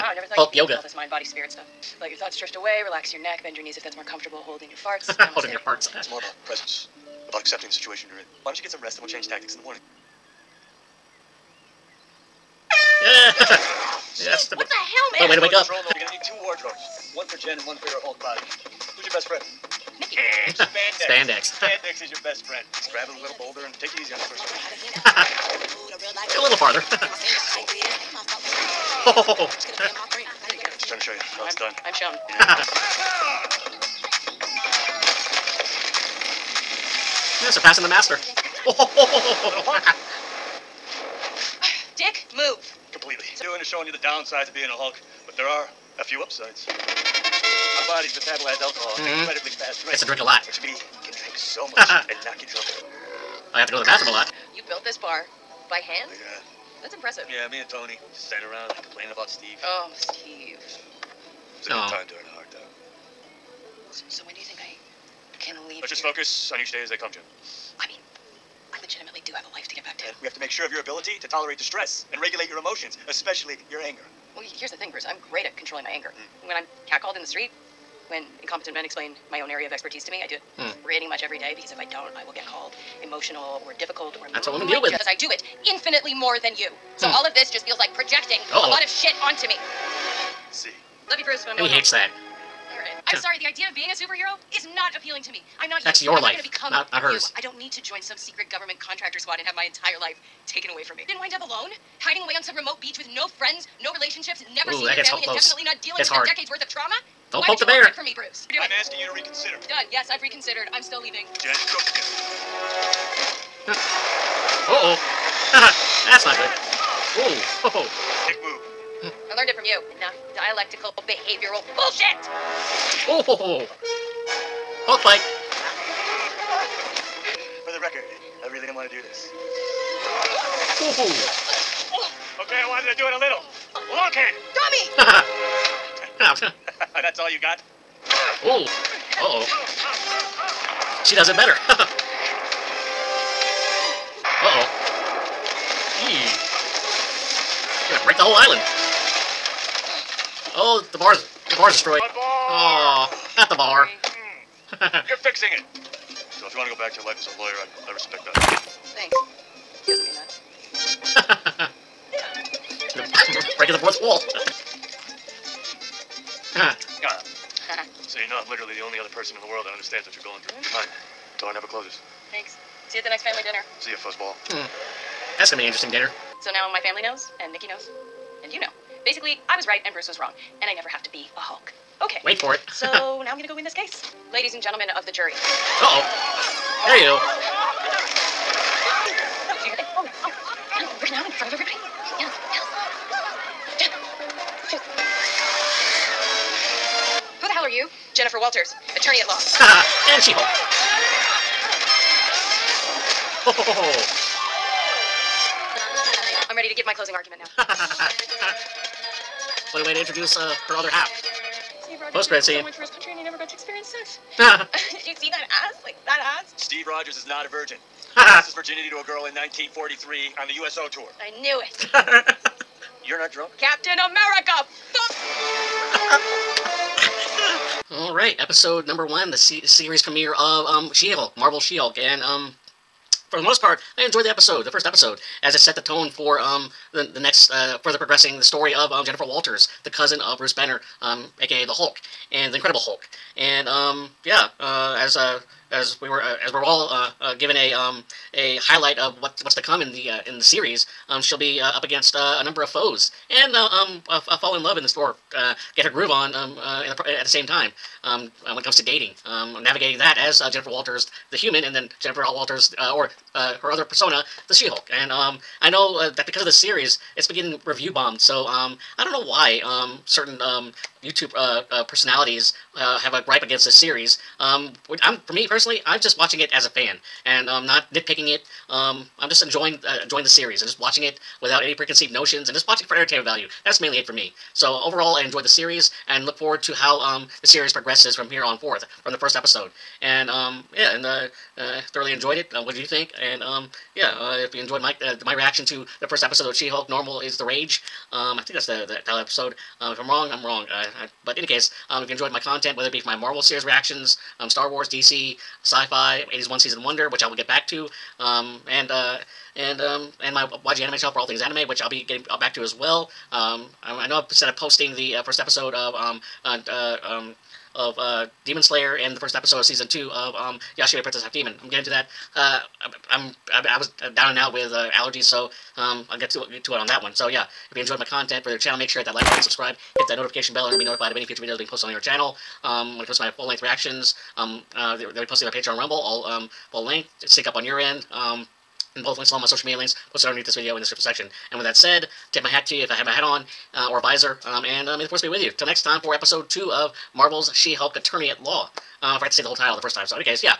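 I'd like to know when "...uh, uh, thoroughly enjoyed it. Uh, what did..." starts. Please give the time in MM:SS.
04:51.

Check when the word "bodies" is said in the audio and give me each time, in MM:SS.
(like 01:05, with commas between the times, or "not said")
00:47.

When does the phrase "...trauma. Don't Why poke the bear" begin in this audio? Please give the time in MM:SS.
01:46.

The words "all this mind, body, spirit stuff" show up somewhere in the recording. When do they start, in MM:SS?
00:00.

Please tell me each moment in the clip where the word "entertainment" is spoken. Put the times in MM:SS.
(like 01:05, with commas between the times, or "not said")
04:42.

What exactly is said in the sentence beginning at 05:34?
Um, uh, they, will be on Patreon Rumble, all um, will link, sync up on your end.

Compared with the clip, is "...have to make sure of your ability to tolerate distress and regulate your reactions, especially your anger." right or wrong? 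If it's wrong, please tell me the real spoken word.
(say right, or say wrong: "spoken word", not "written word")
wrong: "emotions", not "reactions".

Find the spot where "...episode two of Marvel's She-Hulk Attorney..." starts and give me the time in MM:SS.
05:46.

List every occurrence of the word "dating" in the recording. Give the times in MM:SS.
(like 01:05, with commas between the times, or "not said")
04:18.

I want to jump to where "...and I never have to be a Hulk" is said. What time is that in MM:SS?
03:00.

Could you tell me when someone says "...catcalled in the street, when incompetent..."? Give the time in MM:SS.
01:16.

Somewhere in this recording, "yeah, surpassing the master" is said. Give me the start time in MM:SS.
00:37.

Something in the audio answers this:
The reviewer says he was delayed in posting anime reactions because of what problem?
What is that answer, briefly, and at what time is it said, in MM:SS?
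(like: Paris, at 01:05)
allergies, at 05:24.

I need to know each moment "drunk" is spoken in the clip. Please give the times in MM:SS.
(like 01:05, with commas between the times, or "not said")
00:52, 03:43.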